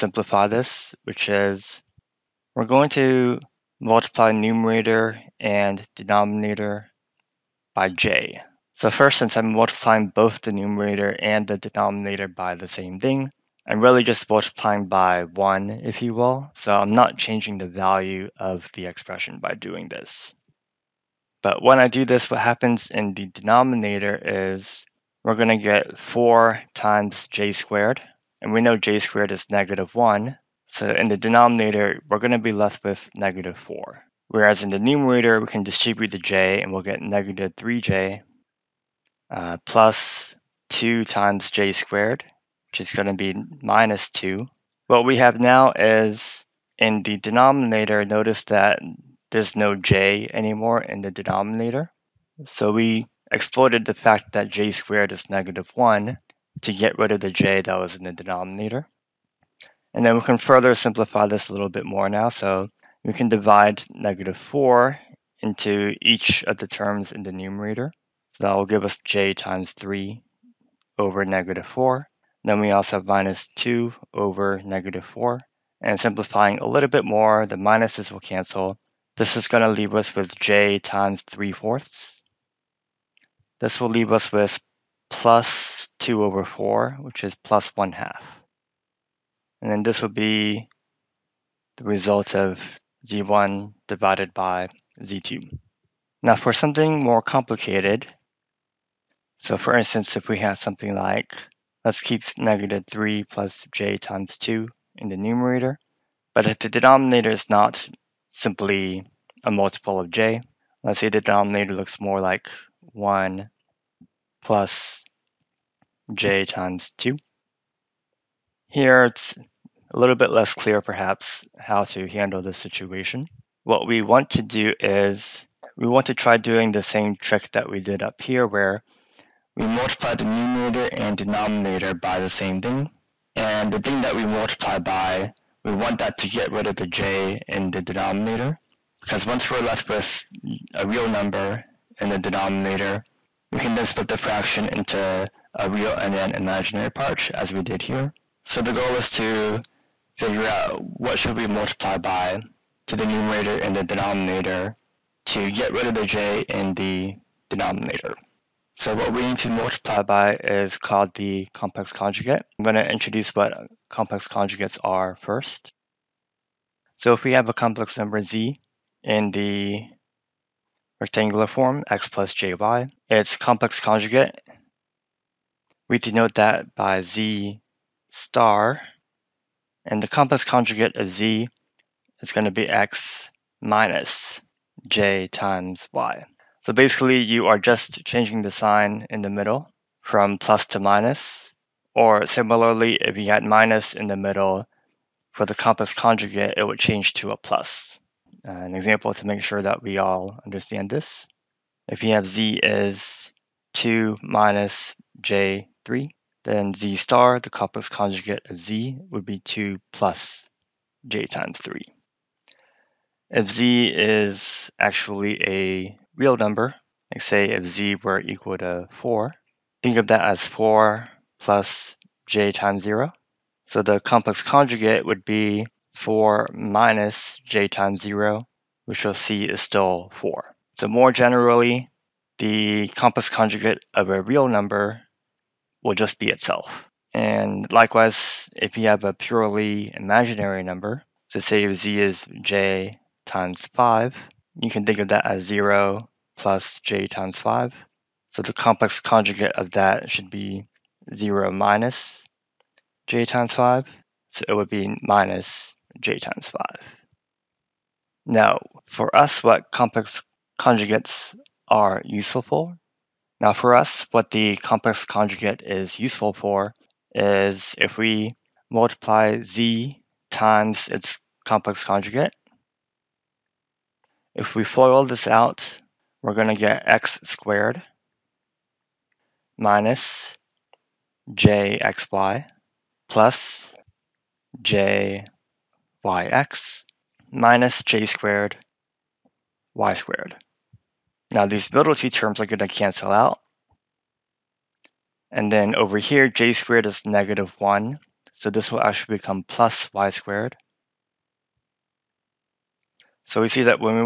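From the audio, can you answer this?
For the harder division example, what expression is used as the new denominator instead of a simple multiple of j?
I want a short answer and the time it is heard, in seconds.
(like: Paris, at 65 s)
1 + j2, at 112 s.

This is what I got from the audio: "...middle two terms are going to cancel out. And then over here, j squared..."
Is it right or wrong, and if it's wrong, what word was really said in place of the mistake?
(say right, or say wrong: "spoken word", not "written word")
right.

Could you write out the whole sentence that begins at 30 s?
So in the denominator, we're going to be left with negative 4.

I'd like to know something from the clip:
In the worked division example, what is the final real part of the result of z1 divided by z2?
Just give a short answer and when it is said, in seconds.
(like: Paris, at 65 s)
1/2, at 87 s.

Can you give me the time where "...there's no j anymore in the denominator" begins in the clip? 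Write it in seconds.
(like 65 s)
49 s.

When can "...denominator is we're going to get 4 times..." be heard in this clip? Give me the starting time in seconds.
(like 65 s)
23 s.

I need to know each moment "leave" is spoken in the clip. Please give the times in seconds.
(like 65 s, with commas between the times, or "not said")
79 s, 83 s.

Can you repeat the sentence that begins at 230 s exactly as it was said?
So more generally, the complex conjugate of a real number will just be itself.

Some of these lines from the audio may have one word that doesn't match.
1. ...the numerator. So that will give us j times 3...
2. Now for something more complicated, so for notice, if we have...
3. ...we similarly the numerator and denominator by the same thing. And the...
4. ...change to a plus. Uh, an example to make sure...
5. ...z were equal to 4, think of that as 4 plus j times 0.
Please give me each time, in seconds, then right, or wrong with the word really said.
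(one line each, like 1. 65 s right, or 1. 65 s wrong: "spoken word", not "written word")
1. 67 s right
2. 96 s wrong: "instance", not "notice"
3. 129 s wrong: "multiply", not "similarly"
4. 196 s right
5. 217 s right.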